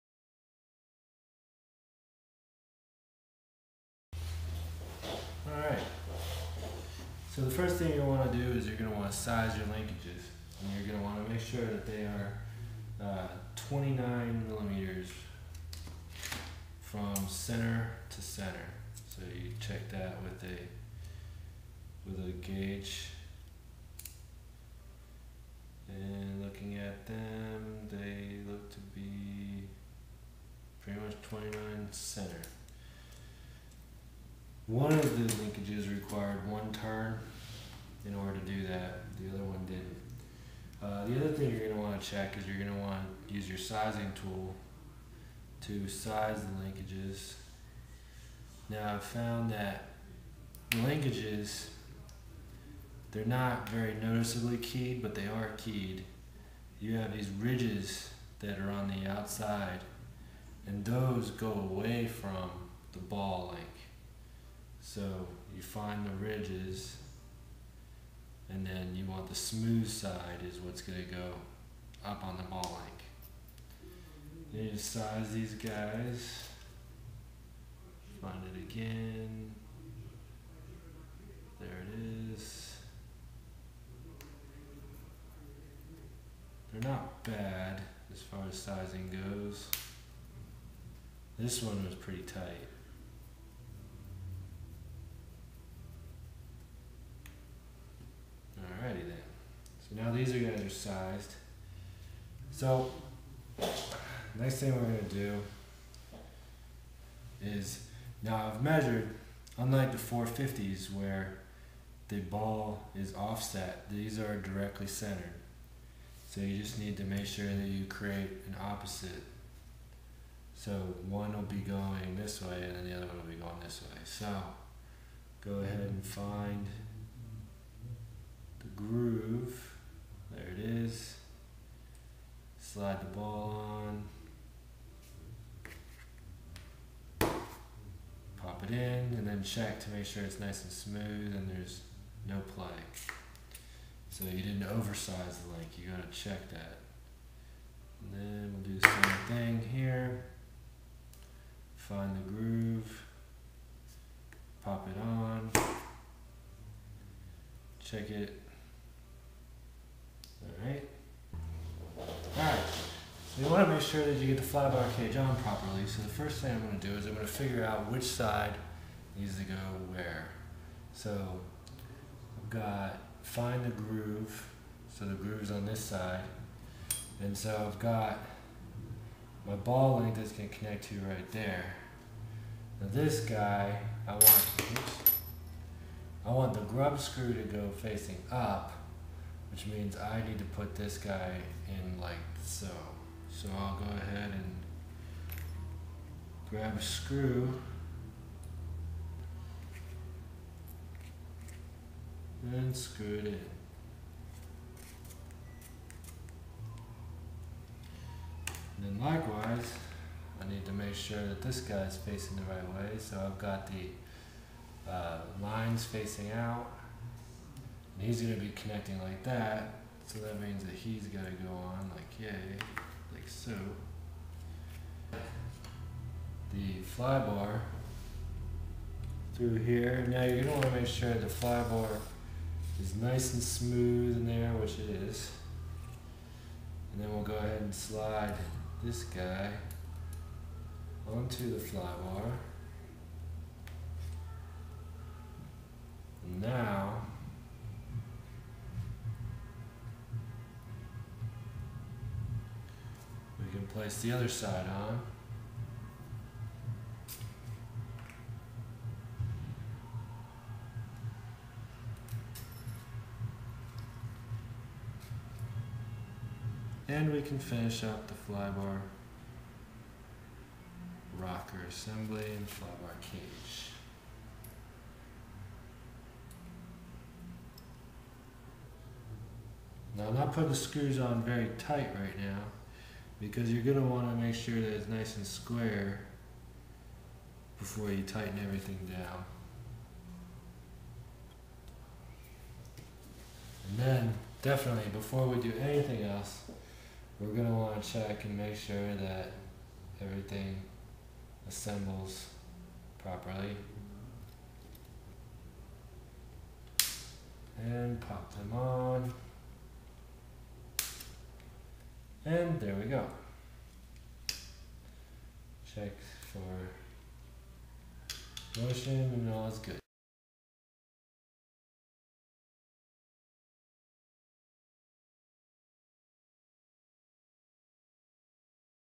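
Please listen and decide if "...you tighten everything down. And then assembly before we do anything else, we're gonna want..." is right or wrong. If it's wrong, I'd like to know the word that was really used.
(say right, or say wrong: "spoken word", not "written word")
wrong: "definitely", not "assembly".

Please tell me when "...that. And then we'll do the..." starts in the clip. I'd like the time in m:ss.
2:26.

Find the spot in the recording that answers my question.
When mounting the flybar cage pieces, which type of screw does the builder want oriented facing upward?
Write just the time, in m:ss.
3:06.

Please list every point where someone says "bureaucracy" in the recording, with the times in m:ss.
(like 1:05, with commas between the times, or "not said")
not said.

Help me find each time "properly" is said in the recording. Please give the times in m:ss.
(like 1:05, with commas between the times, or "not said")
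2:45, 5:02.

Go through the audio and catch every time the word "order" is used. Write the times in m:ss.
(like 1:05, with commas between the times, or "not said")
0:38.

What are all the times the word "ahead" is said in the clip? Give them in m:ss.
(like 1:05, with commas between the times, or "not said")
2:05, 3:13, 3:57.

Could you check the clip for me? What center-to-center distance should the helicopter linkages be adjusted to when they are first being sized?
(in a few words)
29 millimeters.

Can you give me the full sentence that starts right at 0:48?
Now I've found that linkages, they're not very noticeably keyed, but they are keyed.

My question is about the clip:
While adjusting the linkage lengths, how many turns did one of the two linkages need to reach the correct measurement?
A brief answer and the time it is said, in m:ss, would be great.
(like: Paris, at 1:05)
one turn, at 0:36.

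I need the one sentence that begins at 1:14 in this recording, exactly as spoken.
Then you just size these guys, find it again, there it is.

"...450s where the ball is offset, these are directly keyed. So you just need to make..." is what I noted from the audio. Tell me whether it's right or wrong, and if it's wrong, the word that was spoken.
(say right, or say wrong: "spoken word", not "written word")
wrong: "centered", not "keyed".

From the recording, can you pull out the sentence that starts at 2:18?
Pop it in and then check to make sure it's nice and smooth and there's no play.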